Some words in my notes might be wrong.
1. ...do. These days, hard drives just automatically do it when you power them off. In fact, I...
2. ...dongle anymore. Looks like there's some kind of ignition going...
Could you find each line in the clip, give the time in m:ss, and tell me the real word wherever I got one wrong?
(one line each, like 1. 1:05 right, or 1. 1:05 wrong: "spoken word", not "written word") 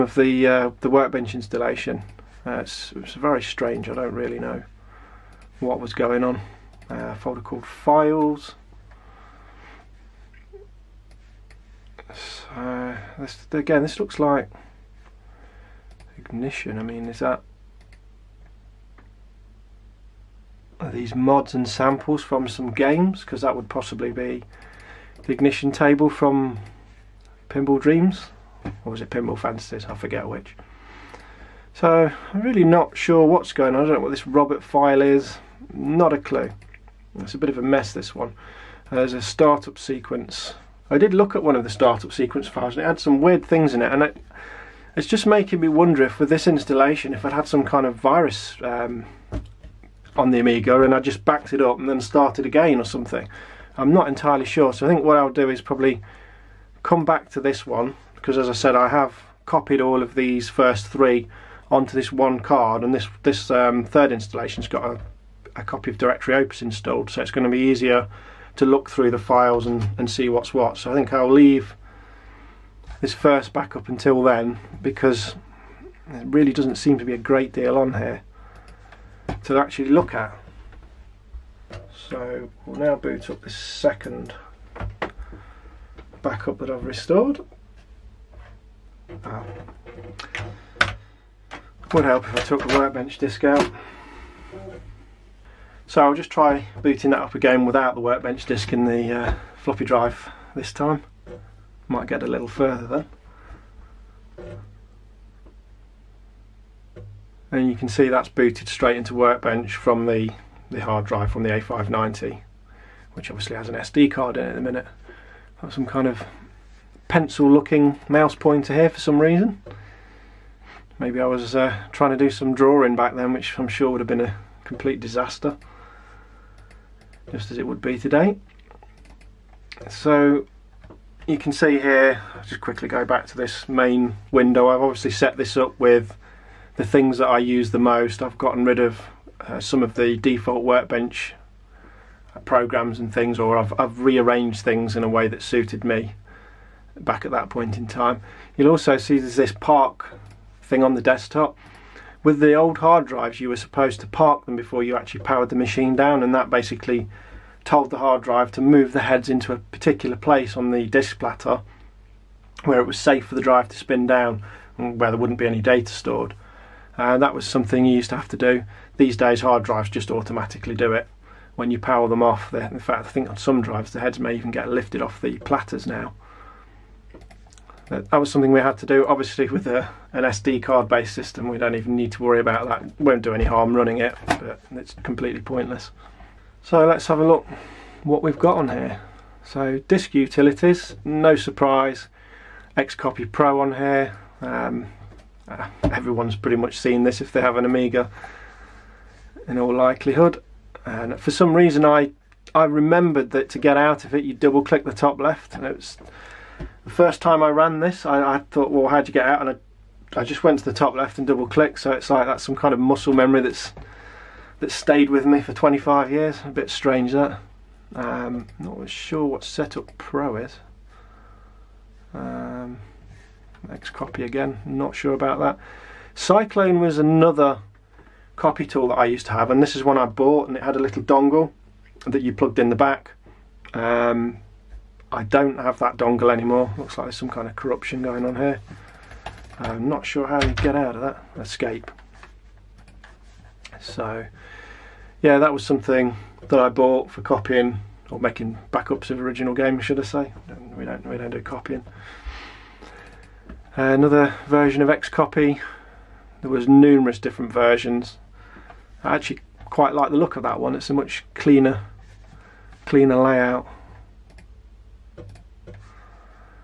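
1. 2:48 right
2. 3:55 wrong: "corruption", not "ignition".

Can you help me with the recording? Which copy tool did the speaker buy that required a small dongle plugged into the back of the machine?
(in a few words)
Cyclone.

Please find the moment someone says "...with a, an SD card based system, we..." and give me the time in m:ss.
2:59.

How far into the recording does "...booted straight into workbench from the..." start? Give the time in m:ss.
1:48.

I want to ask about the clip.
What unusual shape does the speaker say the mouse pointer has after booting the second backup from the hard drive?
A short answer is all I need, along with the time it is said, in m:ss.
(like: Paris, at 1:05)
Pencil, at 1:57.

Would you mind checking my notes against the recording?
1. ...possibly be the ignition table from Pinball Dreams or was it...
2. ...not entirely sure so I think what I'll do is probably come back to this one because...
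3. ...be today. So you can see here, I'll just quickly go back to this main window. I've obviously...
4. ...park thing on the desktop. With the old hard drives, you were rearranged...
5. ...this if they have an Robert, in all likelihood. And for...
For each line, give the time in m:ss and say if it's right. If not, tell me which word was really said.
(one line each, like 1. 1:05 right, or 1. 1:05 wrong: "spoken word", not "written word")
1. 0:23 right
2. 0:53 right
3. 2:07 right
4. 2:29 wrong: "supposed", not "rearranged"
5. 3:17 wrong: "Amiga", not "Robert".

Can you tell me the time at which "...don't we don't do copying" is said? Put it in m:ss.
4:10.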